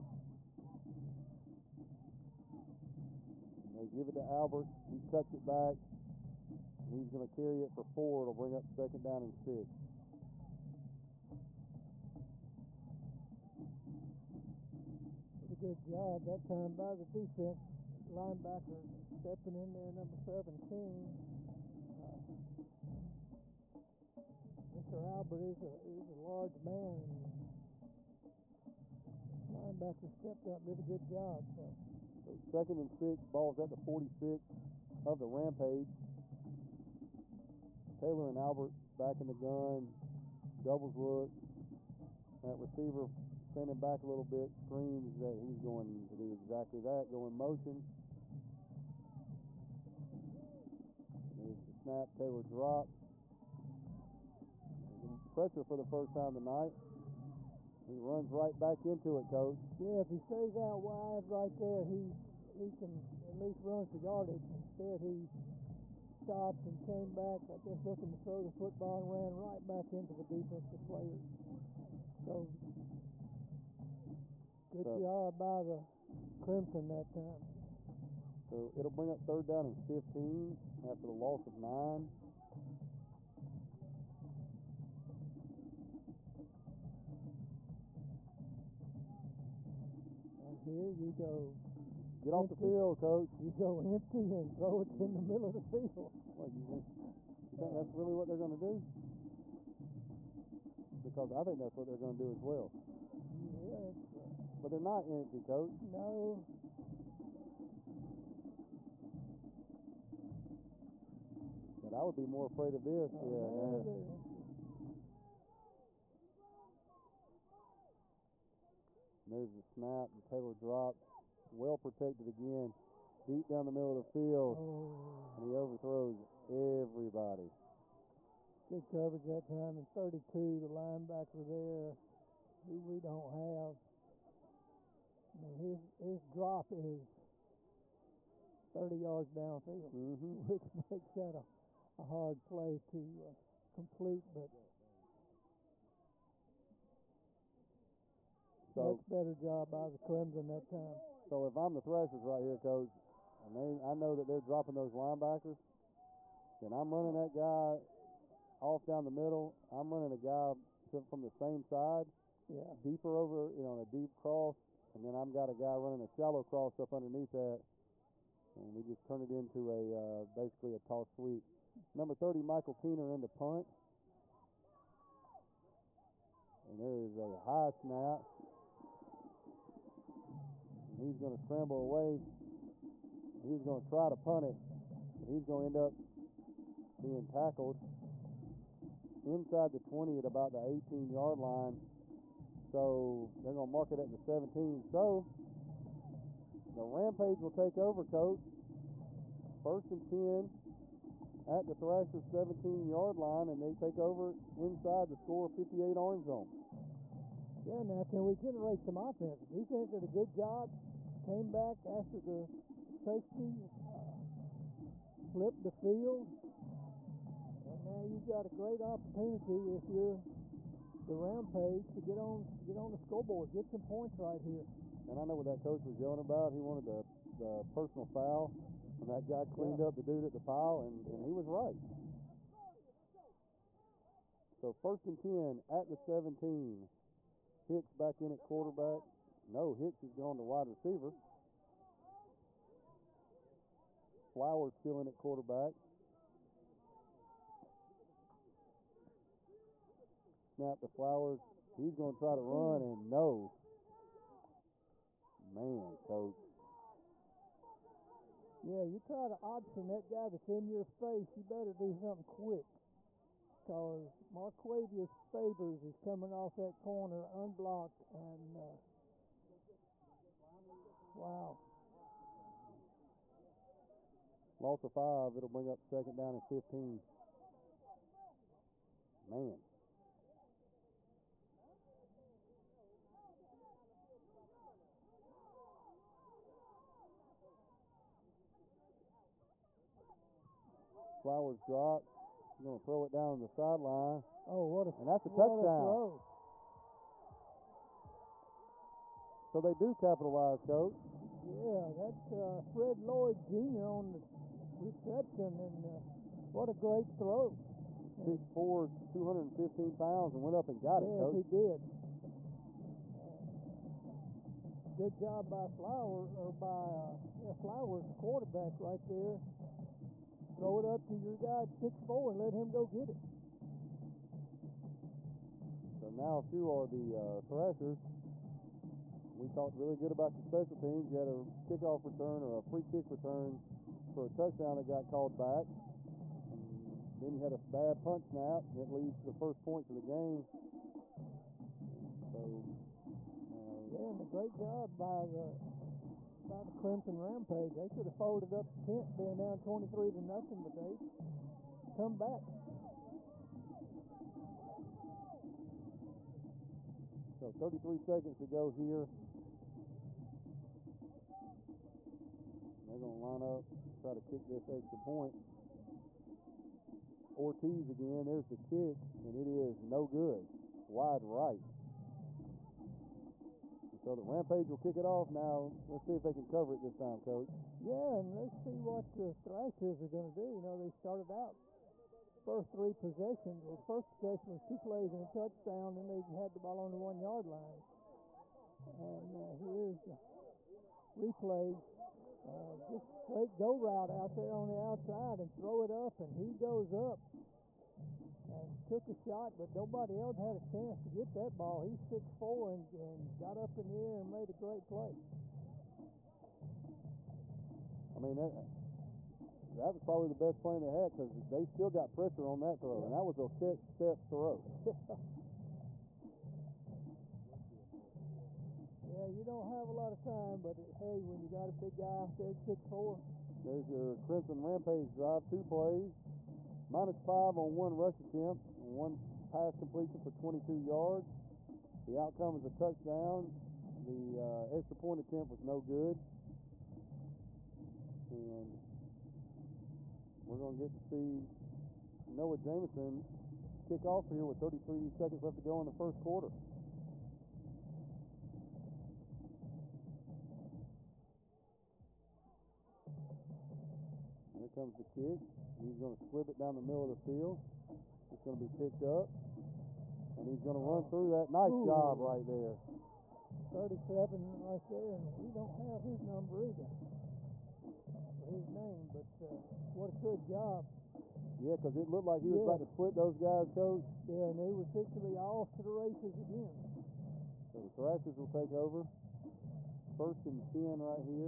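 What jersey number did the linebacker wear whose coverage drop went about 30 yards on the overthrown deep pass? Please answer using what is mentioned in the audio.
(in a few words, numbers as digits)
32.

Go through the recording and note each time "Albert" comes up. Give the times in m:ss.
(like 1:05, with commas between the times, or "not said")
0:04, 0:25, 0:38.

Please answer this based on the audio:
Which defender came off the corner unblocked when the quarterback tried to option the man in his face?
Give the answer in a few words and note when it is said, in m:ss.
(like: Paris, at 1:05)
Marquavius Favors, at 4:24.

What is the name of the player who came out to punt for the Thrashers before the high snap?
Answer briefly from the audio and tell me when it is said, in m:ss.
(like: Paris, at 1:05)
Michael Keener, at 2:52.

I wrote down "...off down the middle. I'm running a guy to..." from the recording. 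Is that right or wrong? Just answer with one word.
right.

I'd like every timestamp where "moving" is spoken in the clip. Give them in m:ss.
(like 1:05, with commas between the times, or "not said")
not said.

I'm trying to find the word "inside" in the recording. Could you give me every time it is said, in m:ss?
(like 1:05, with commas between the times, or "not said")
3:09, 3:24.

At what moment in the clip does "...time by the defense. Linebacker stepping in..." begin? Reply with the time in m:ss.
0:16.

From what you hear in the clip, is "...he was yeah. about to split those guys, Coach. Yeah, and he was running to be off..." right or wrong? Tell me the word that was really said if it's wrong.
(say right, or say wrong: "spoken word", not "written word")
wrong: "fixing", not "running".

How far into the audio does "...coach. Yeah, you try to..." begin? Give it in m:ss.
4:16.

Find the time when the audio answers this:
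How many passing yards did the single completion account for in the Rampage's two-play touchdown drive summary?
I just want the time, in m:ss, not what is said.
7:10.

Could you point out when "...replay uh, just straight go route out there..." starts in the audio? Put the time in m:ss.
6:31.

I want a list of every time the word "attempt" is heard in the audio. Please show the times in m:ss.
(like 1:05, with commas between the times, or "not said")
7:08, 7:15.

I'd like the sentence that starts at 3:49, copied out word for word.
up the dude at the pile, and, yeah.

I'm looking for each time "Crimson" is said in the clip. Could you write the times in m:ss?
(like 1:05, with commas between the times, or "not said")
1:16, 2:29, 5:46, 7:04.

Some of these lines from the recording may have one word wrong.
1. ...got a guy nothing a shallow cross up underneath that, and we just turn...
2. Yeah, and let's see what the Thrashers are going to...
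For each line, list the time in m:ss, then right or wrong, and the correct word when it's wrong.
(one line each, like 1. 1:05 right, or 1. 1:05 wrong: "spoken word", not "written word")
1. 2:45 wrong: "running", not "nothing"
2. 6:17 right.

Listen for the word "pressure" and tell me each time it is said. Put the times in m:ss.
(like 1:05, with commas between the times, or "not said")
0:55, 6:52.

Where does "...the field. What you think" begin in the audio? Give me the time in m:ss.
1:35.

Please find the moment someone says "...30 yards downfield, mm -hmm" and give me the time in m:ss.
2:18.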